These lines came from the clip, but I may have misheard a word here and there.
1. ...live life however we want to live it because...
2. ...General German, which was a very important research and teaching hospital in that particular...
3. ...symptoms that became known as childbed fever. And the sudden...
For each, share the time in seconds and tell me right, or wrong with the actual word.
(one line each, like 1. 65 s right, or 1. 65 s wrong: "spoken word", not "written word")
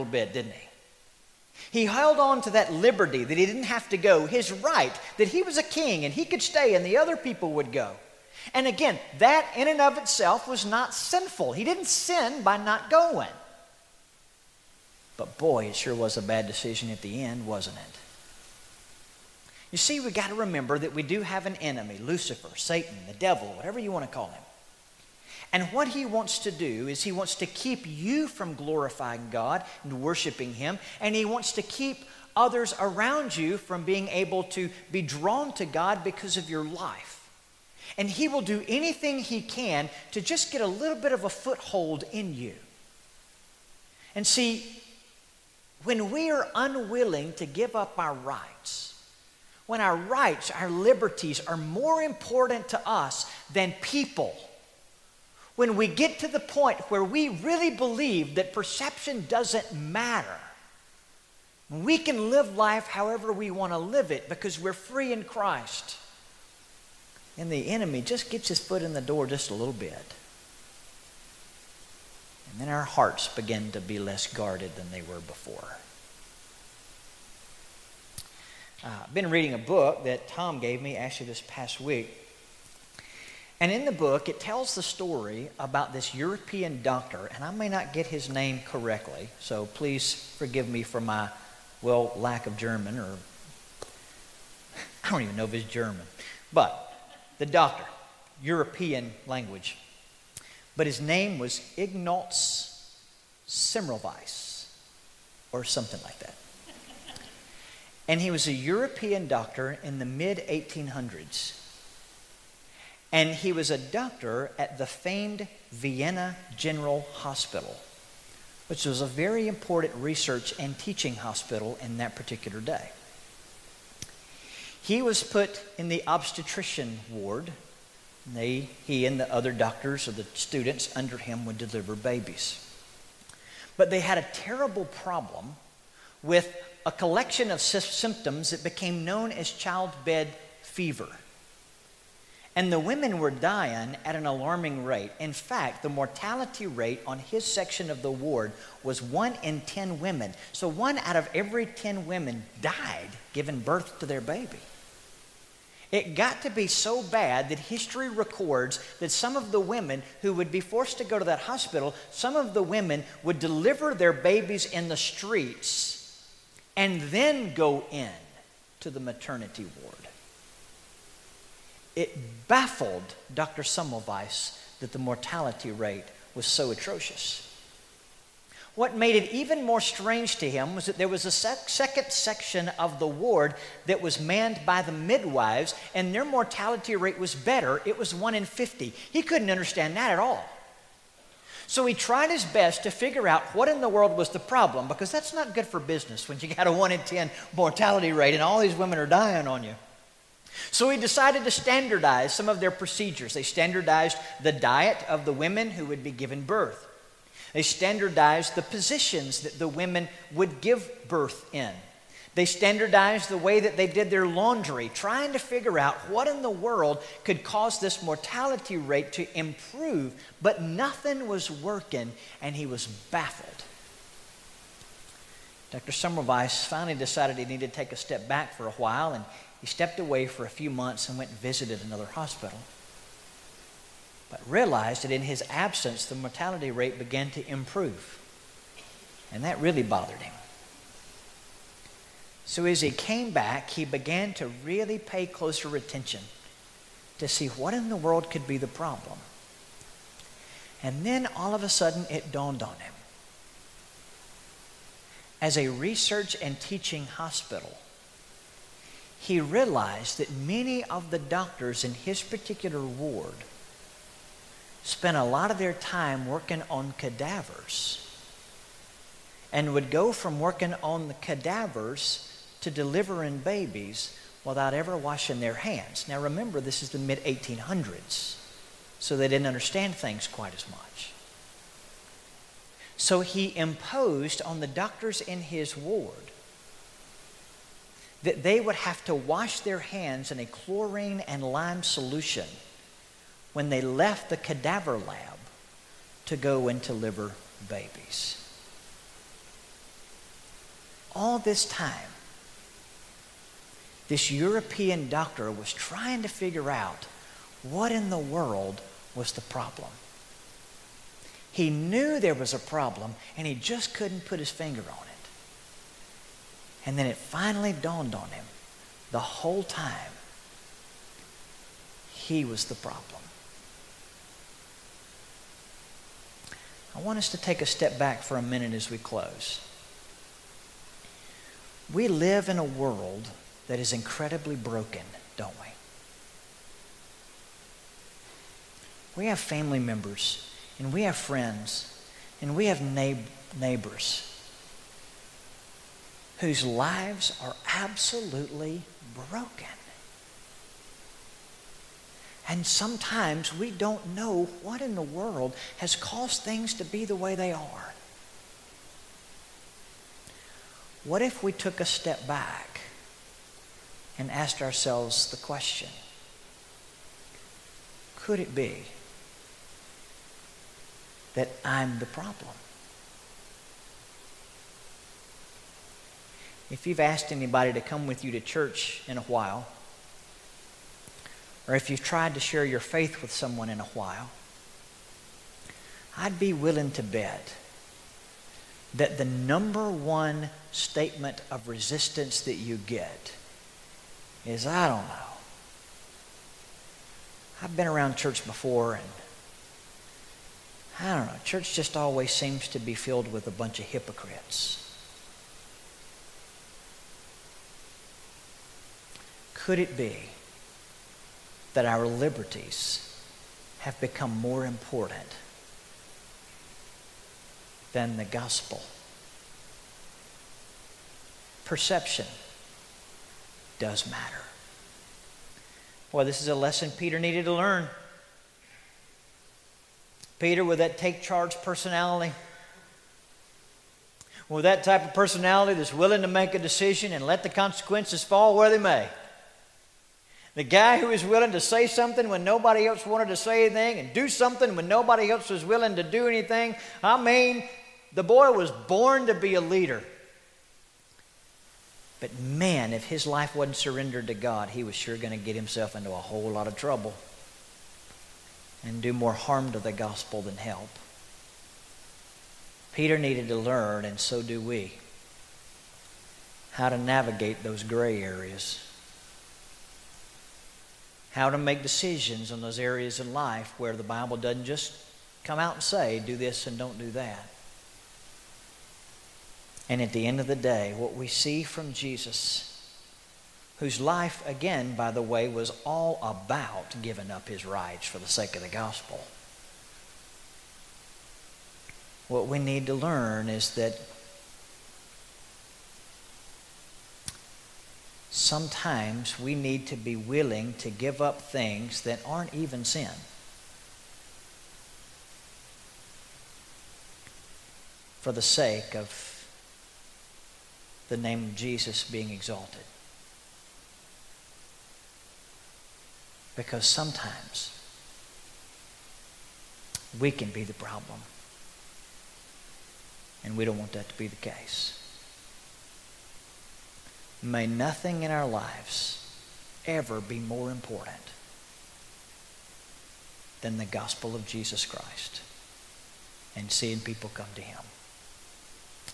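1. 62 s right
2. 116 s wrong: "Hospital", not "German"
3. 137 s wrong: "women", not "sudden".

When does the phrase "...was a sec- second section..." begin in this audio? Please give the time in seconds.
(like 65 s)
181 s.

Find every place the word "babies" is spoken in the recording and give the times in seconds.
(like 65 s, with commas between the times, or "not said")
131 s, 164 s, 273 s, 297 s.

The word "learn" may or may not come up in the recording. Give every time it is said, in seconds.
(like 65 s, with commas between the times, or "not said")
427 s, 463 s, 492 s.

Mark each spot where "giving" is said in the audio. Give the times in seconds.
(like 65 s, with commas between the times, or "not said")
153 s, 487 s.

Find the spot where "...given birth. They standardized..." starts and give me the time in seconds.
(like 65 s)
206 s.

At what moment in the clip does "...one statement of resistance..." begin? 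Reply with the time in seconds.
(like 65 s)
389 s.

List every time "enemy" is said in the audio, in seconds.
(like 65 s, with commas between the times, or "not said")
21 s, 67 s.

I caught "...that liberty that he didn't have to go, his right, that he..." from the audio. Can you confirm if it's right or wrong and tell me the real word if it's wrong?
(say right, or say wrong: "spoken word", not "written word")
right.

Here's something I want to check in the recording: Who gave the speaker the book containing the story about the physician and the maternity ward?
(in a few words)
Tom.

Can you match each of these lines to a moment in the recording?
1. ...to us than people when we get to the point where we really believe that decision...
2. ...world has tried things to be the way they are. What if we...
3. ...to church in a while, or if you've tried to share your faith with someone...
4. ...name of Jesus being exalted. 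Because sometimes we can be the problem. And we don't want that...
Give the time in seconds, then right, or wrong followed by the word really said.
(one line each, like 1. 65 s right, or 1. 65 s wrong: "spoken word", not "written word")
1. 52 s wrong: "perception", not "decision"
2. 355 s wrong: "caused", not "tried"
3. 378 s right
4. 511 s right.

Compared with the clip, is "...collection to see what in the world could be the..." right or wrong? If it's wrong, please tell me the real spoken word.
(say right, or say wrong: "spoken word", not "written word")
wrong: "attention", not "collection".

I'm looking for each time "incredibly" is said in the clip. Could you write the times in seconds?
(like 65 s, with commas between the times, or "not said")
333 s.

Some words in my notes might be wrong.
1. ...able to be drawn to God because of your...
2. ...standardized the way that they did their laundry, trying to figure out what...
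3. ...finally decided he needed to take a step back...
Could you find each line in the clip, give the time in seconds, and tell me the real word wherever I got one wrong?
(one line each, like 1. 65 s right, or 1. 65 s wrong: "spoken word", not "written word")
1. 34 s right
2. 212 s right
3. 226 s right.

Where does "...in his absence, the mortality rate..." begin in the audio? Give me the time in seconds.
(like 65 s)
235 s.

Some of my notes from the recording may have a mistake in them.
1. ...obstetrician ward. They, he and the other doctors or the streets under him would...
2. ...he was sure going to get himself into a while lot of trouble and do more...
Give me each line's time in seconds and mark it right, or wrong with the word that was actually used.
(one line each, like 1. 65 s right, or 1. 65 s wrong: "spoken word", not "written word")
1. 126 s wrong: "students", not "streets"
2. 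454 s wrong: "whole", not "while".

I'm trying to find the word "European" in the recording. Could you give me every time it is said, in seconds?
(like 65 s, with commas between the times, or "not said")
86 s, 98 s, 108 s, 304 s.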